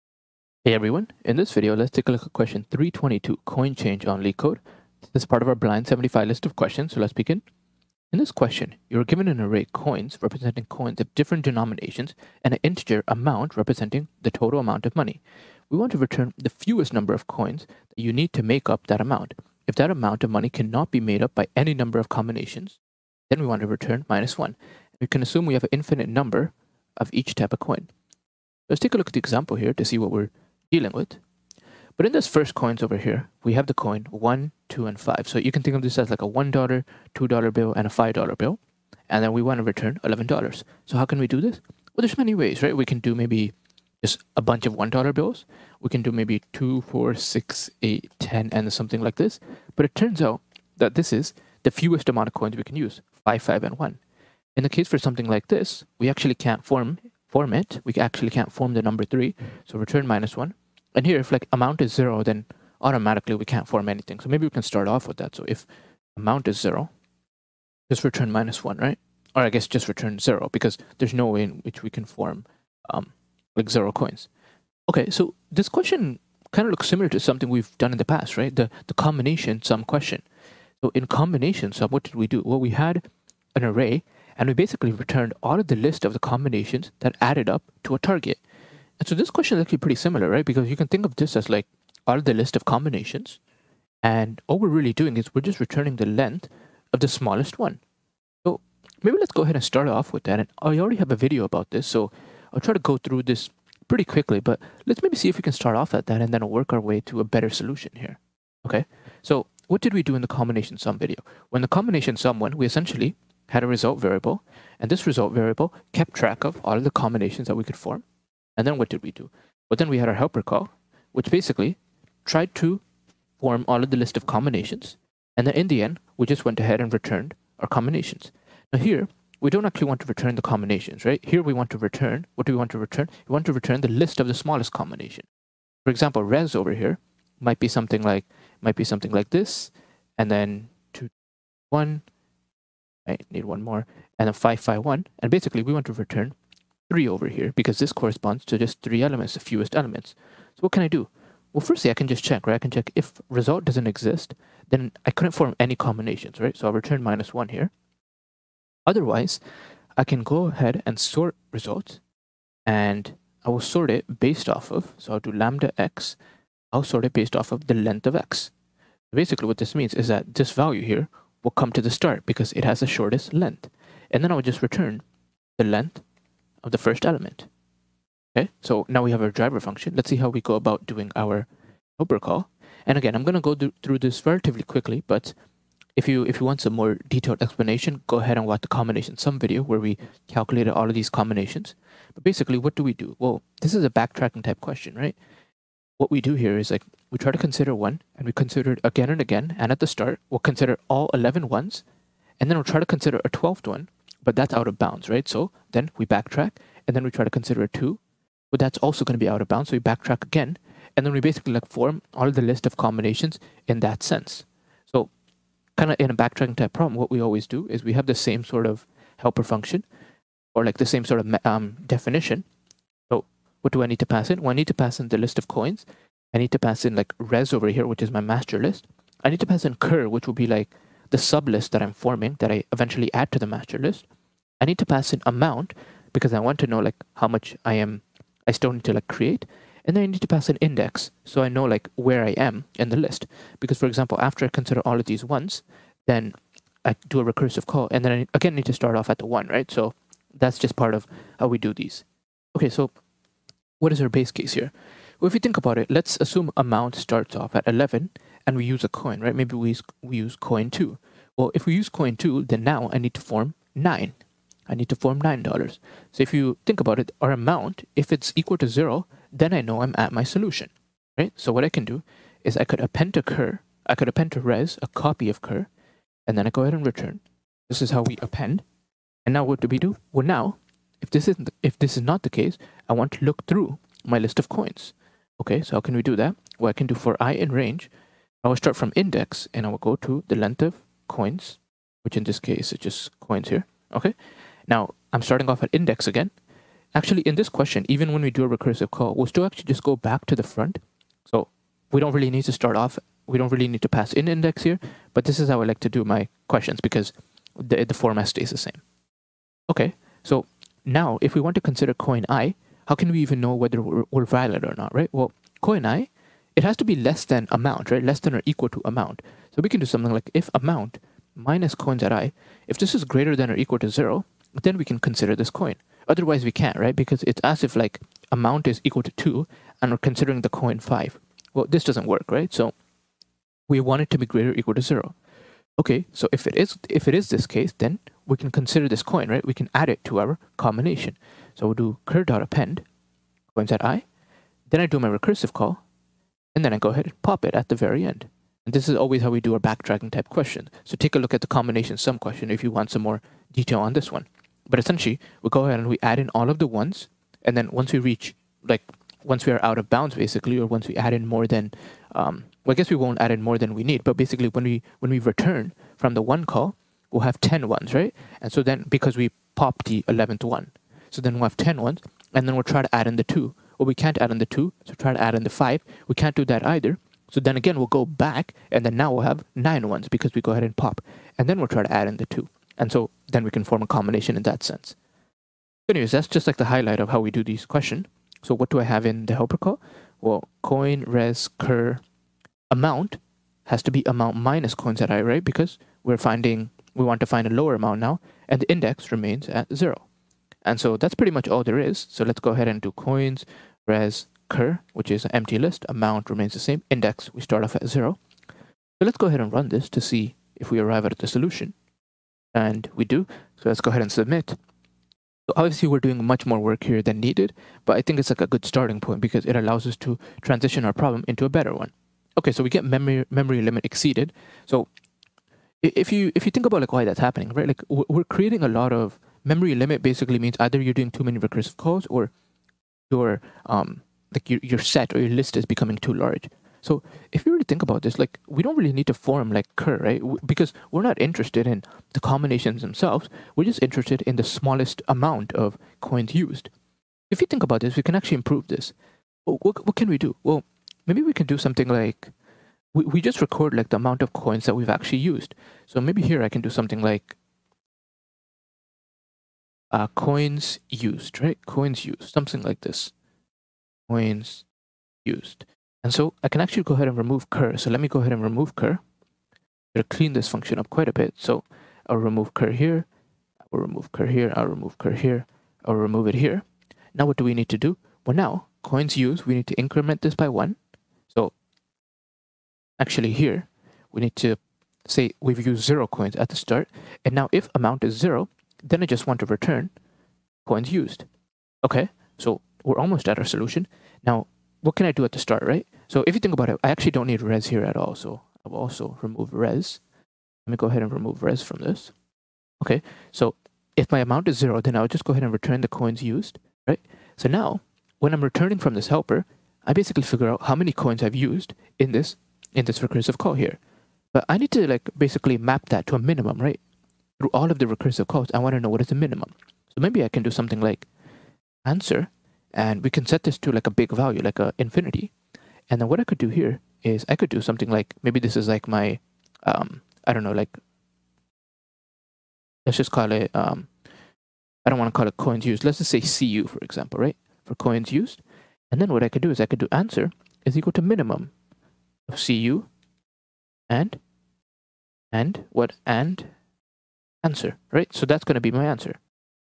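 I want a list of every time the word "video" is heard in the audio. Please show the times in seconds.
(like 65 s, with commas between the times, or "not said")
1 s, 101 s, 110 s, 189 s.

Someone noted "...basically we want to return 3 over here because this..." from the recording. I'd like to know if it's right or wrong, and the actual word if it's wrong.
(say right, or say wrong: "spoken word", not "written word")
right.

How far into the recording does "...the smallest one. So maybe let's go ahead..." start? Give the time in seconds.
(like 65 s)
97 s.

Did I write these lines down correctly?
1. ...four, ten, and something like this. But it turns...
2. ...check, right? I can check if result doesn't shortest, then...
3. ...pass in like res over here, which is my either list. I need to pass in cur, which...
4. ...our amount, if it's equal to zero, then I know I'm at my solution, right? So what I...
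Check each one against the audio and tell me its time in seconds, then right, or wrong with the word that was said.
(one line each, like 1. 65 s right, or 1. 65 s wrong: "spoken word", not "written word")
1. 47 s wrong: "eight", not "four"
2. 152 s wrong: "exist", not "shortest"
3. 226 s wrong: "master", not "either"
4. 267 s right.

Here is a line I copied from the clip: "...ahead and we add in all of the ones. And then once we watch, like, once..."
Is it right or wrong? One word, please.
wrong.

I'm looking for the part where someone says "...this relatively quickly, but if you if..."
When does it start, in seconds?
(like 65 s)
183 s.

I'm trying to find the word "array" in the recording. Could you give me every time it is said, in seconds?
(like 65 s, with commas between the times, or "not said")
9 s, 83 s.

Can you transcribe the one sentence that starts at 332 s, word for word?
So we want it to be greater or equal to 0.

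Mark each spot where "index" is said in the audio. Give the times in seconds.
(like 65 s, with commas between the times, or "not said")
240 s, 288 s, 295 s, 304 s, 398 s, 406 s.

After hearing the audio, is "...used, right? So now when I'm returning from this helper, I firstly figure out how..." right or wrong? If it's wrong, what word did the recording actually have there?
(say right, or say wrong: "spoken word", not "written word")
wrong: "basically", not "firstly".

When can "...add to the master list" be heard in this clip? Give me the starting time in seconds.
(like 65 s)
233 s.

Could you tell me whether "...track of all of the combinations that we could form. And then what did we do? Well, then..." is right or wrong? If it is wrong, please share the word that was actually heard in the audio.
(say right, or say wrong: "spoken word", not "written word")
right.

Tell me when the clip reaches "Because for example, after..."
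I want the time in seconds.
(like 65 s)
243 s.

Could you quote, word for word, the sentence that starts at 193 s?
Well, this is a backtracking type question, right?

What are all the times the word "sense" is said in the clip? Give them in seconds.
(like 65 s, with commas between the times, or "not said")
214 s, 384 s.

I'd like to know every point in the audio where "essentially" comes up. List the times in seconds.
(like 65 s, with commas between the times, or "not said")
112 s, 354 s.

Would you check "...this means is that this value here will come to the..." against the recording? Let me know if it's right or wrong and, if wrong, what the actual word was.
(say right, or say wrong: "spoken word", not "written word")
right.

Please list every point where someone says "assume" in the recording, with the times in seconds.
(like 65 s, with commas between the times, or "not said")
25 s, 256 s.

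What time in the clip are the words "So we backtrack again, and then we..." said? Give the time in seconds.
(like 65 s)
209 s.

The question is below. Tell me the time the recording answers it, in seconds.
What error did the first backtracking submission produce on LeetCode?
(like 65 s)
422 s.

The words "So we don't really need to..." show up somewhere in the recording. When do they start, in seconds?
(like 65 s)
301 s.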